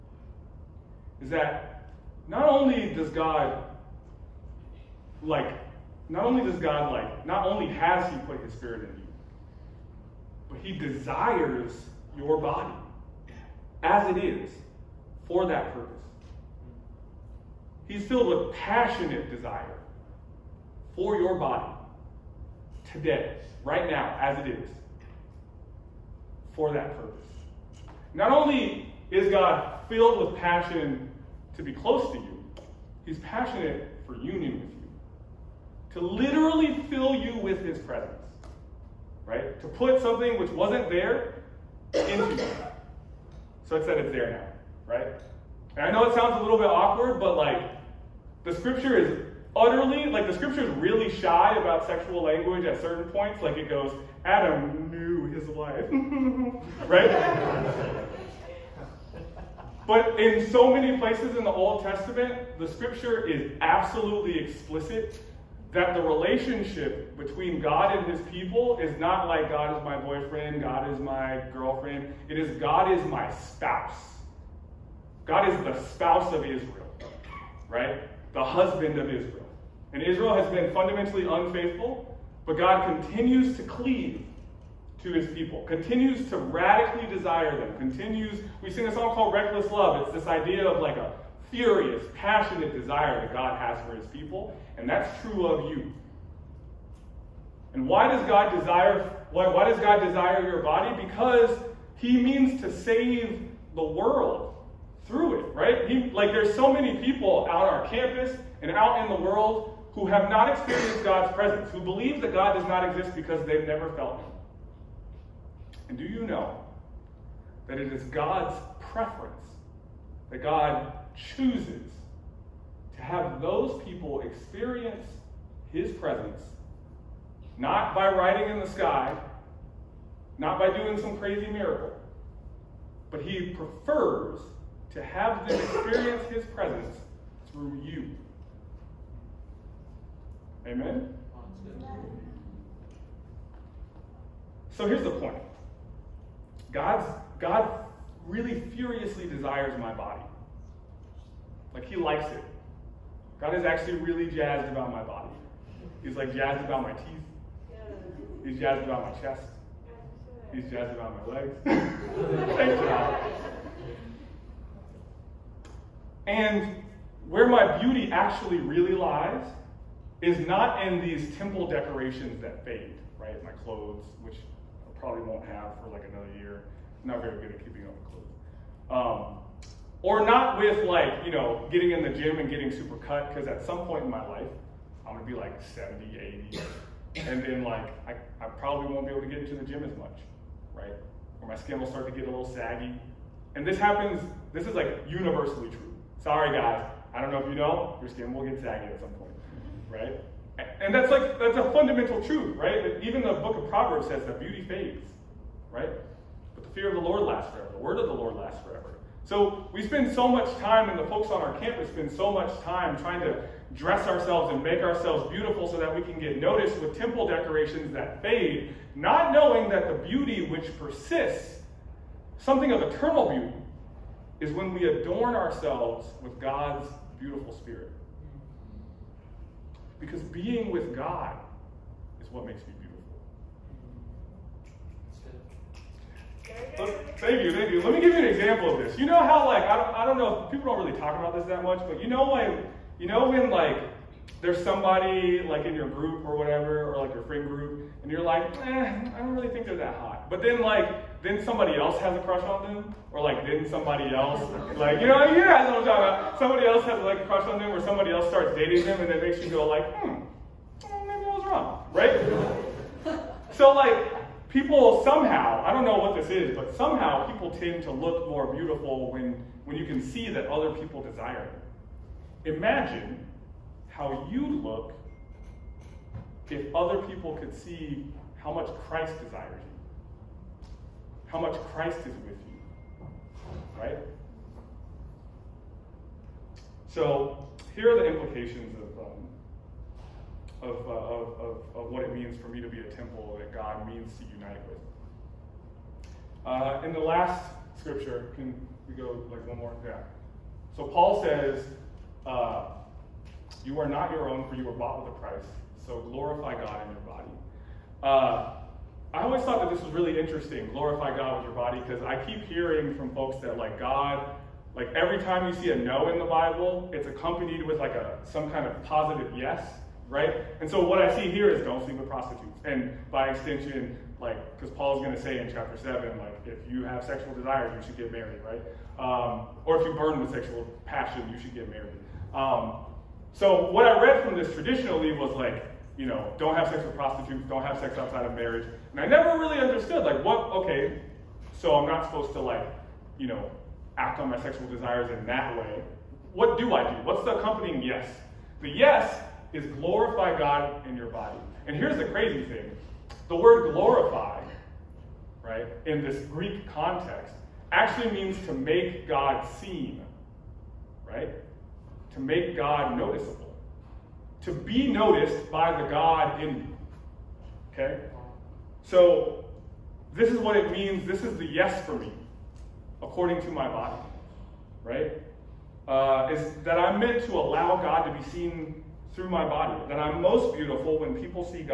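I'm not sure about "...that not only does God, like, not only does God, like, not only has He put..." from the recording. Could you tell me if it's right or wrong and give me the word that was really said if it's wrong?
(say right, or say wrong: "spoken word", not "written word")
right.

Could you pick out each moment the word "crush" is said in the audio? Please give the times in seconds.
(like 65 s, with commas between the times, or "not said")
252 s, 257 s.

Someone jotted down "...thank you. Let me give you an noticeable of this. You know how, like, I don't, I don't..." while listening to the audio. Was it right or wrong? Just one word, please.
wrong.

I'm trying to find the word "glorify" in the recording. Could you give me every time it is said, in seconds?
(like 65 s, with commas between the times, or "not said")
306 s, 310 s, 349 s, 353 s.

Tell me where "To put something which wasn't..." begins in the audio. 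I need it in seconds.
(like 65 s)
39 s.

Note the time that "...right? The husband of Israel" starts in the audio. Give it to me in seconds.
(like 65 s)
77 s.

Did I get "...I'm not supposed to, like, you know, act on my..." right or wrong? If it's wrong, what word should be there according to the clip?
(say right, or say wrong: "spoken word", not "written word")
right.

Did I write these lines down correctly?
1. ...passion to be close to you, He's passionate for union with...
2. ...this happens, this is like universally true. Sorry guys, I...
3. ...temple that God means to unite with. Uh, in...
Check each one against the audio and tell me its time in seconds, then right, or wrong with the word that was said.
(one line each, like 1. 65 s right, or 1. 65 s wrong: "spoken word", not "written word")
1. 30 s right
2. 193 s right
3. 292 s right.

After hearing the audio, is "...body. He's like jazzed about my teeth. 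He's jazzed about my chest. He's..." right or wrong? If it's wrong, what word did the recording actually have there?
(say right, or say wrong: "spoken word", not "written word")
right.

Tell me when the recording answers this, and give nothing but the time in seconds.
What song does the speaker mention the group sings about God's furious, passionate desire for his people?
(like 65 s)
89 s.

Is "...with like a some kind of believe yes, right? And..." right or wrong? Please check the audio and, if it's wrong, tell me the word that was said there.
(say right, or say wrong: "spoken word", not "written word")
wrong: "positive", not "believe".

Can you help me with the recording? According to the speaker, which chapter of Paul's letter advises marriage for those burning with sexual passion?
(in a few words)
Chapter 7.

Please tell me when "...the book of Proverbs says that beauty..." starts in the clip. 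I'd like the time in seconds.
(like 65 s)
203 s.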